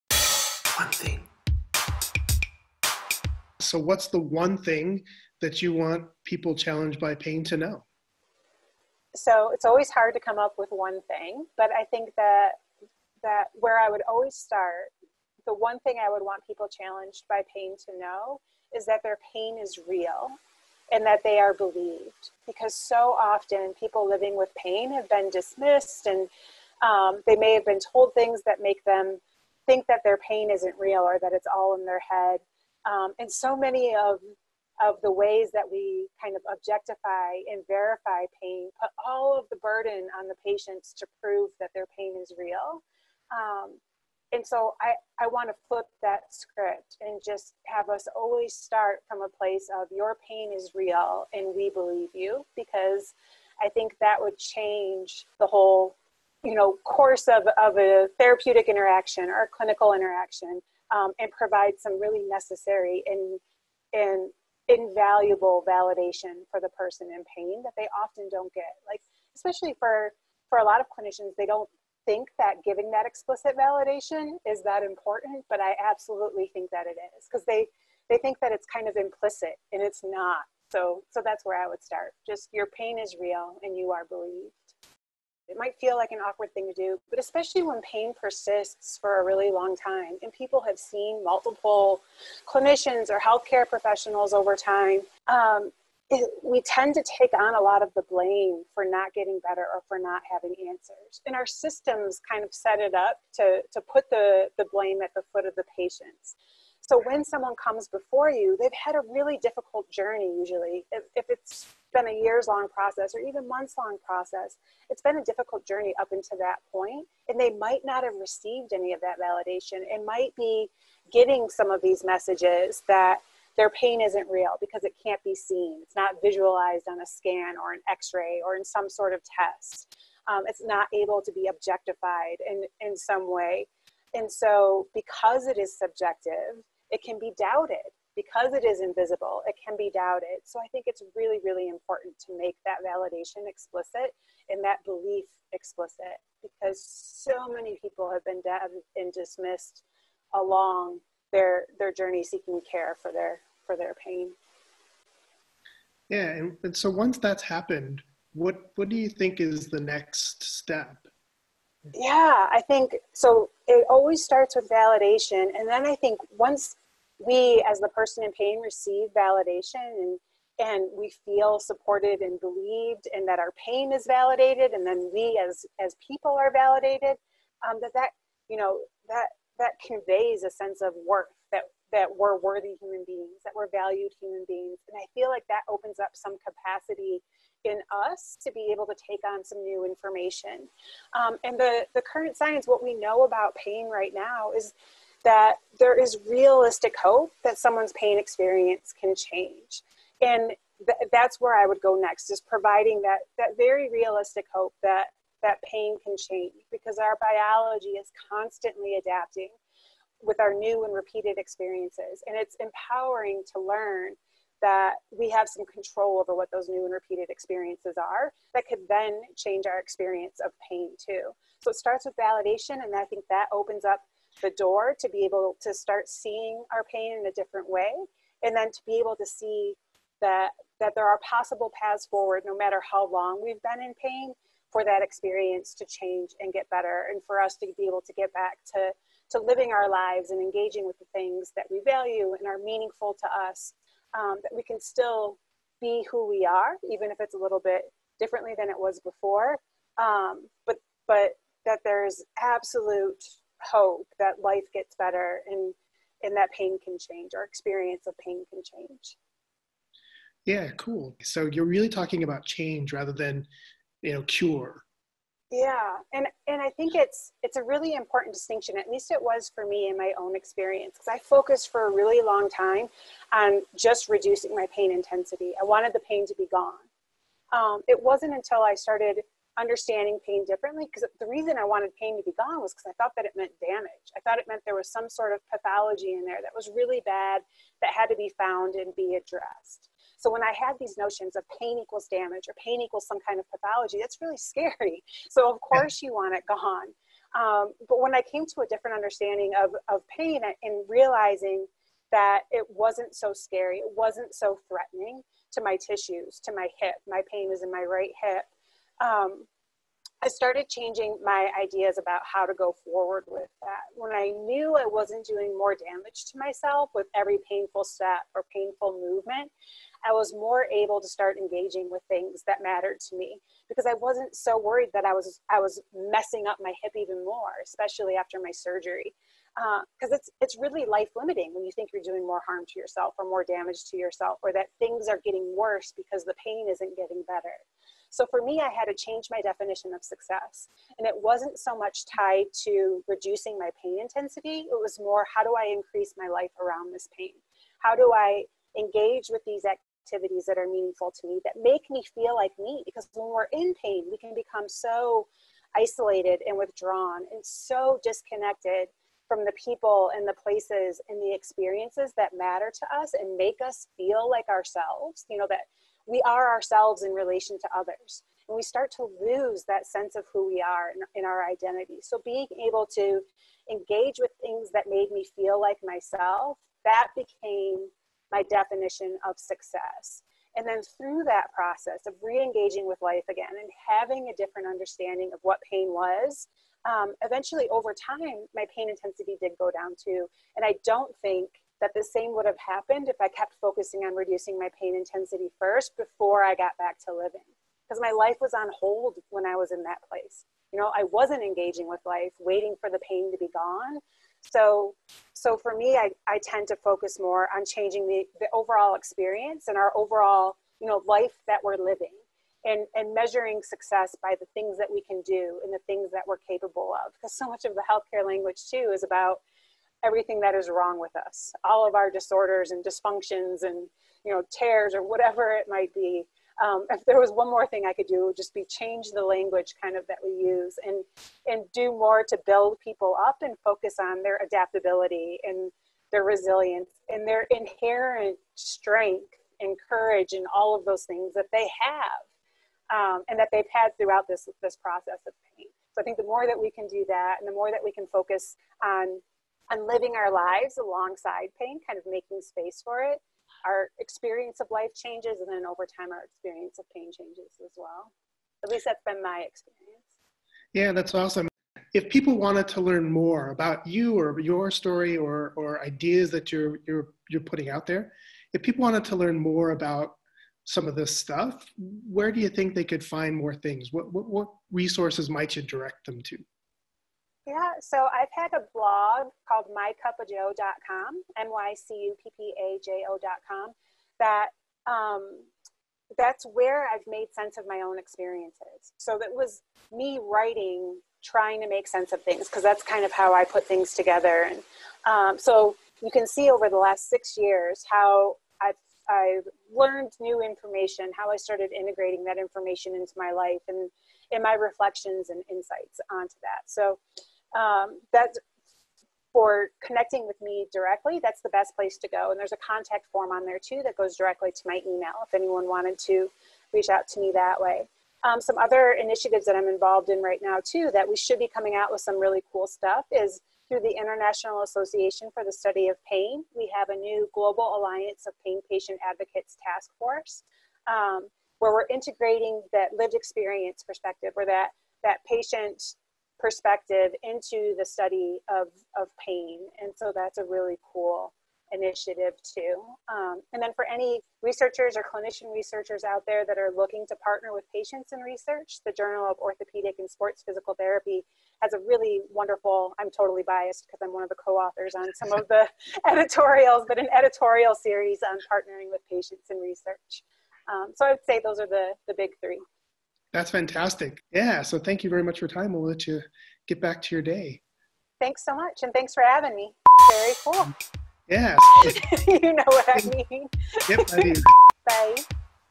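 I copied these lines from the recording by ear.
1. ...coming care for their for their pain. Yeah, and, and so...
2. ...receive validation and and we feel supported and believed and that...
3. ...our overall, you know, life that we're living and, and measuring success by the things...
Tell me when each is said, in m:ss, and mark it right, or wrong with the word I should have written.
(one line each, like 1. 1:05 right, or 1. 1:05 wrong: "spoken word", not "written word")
1. 2:32 wrong: "seeking", not "coming"
2. 2:48 right
3. 6:49 right.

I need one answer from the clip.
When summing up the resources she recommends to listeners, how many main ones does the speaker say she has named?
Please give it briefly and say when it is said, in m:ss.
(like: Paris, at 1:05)
3, at 9:22.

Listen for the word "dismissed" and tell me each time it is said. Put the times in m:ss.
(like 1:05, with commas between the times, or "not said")
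0:25, 2:29.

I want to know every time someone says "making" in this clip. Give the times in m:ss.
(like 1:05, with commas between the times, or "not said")
7:32.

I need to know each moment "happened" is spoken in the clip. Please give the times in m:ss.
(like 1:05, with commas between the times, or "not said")
2:37, 6:32.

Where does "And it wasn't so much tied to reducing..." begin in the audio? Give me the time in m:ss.
5:40.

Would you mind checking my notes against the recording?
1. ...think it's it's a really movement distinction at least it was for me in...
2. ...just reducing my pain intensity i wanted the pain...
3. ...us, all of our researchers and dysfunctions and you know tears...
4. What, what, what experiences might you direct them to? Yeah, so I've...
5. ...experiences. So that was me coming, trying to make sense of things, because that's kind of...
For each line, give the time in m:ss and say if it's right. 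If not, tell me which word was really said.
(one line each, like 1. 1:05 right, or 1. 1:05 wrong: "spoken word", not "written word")
1. 4:26 wrong: "important", not "movement"
2. 4:33 right
3. 7:01 wrong: "disorders", not "researchers"
4. 7:53 wrong: "resources", not "experiences"
5. 8:07 wrong: "writing", not "coming".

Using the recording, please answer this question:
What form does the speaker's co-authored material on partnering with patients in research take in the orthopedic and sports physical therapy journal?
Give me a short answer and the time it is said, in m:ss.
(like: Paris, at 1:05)
editorial series, at 9:17.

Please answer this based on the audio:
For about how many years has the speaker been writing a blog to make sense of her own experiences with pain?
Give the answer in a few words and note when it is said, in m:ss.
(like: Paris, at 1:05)
6 years, at 8:17.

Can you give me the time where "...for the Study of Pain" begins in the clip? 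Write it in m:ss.
8:45.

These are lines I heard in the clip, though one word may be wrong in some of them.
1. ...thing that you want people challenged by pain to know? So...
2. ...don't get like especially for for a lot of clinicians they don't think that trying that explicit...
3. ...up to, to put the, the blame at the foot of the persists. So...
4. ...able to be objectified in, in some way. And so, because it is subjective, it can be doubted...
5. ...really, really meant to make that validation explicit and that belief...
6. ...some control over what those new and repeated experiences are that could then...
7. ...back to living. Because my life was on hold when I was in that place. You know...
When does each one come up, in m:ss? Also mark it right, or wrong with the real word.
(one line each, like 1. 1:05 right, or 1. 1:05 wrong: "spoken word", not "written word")
1. 0:04 right
2. 1:08 wrong: "giving", not "trying"
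3. 1:42 wrong: "patients", not "persists"
4. 2:10 right
5. 2:21 wrong: "important", not "meant"
6. 3:35 right
7. 6:36 right.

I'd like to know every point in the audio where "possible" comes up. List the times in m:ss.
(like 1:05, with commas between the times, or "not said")
3:51.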